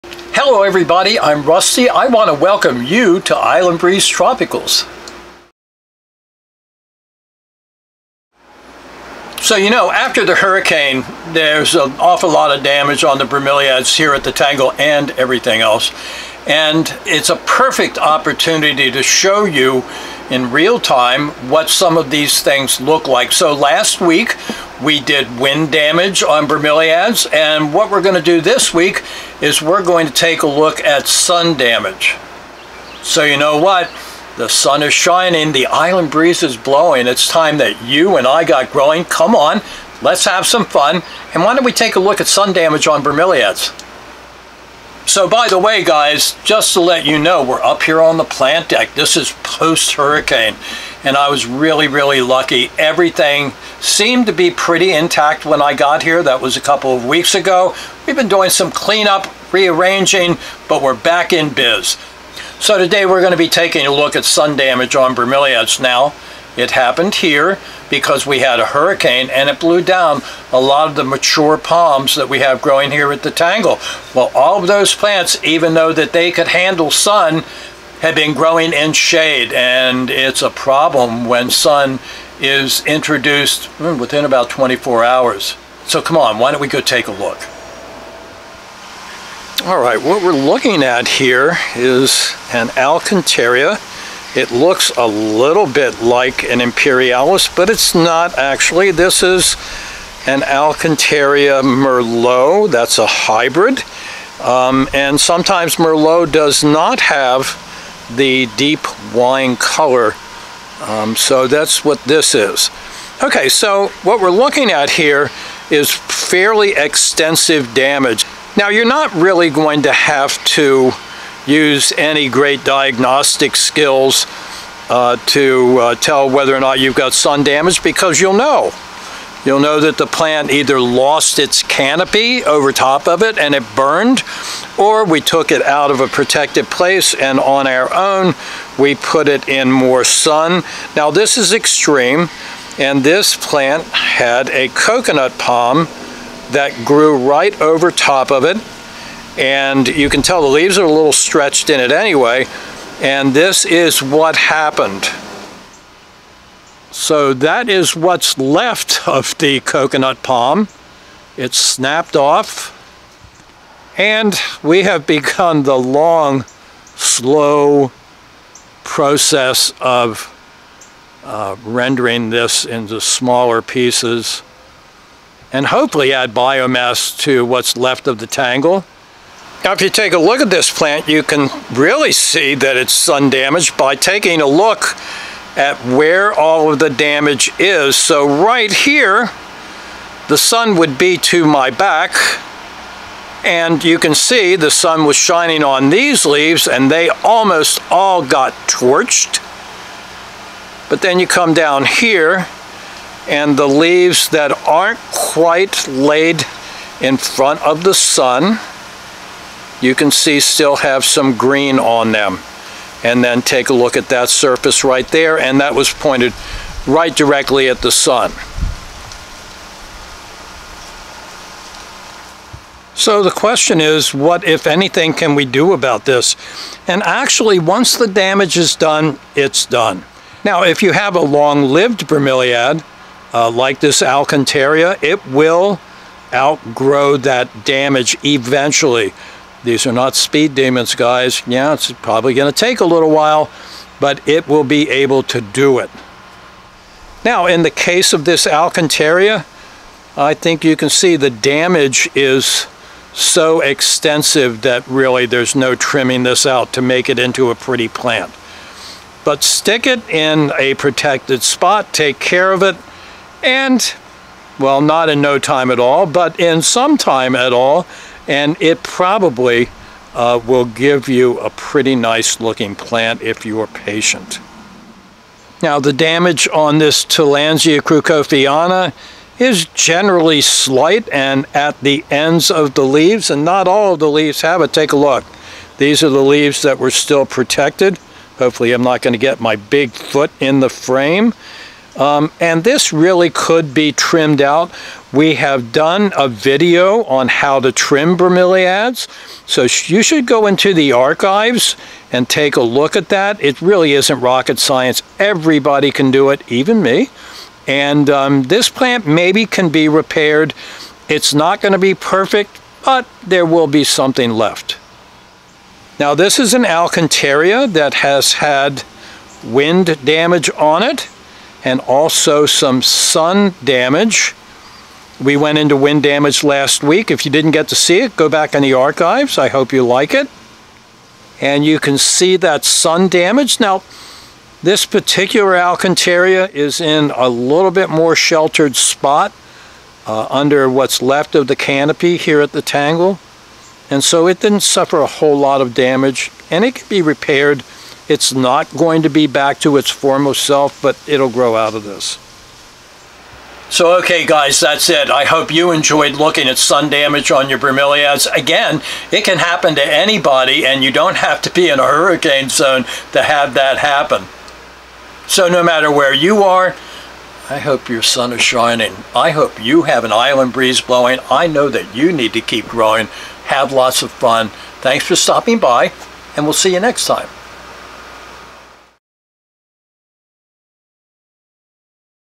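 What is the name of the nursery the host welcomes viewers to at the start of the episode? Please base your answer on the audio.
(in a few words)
Island Breeze Tropicals.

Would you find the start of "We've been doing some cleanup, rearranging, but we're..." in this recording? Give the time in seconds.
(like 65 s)
58 s.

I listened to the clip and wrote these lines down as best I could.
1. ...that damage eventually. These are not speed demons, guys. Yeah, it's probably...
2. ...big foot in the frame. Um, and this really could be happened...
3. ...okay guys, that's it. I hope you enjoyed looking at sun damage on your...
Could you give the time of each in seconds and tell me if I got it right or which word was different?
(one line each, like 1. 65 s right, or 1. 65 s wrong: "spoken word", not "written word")
1. 237 s right
2. 289 s wrong: "trimmed", not "happened"
3. 353 s right.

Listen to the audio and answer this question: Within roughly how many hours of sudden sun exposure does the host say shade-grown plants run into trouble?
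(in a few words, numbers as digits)
24 hours.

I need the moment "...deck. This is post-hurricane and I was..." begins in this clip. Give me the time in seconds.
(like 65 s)
48 s.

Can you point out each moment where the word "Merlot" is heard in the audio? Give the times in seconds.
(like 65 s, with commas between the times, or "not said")
101 s, 105 s.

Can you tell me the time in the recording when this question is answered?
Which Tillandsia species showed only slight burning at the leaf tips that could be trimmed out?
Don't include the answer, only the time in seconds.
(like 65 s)
277 s.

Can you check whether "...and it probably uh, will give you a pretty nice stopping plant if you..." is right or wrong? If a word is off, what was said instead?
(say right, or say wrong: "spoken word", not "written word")
wrong: "looking", not "stopping".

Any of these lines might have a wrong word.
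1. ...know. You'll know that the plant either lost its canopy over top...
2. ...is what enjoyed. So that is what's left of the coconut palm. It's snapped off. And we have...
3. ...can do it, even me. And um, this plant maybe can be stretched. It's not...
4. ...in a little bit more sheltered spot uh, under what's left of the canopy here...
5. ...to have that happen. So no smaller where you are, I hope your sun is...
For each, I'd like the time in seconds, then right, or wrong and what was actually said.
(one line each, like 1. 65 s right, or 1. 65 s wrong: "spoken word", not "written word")
1. 128 s right
2. 153 s wrong: "happened", not "enjoyed"
3. 305 s wrong: "repaired", not "stretched"
4. 336 s right
5. 363 s wrong: "matter", not "smaller".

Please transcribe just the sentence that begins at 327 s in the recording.
If you didn't get to see it, go back in the archives.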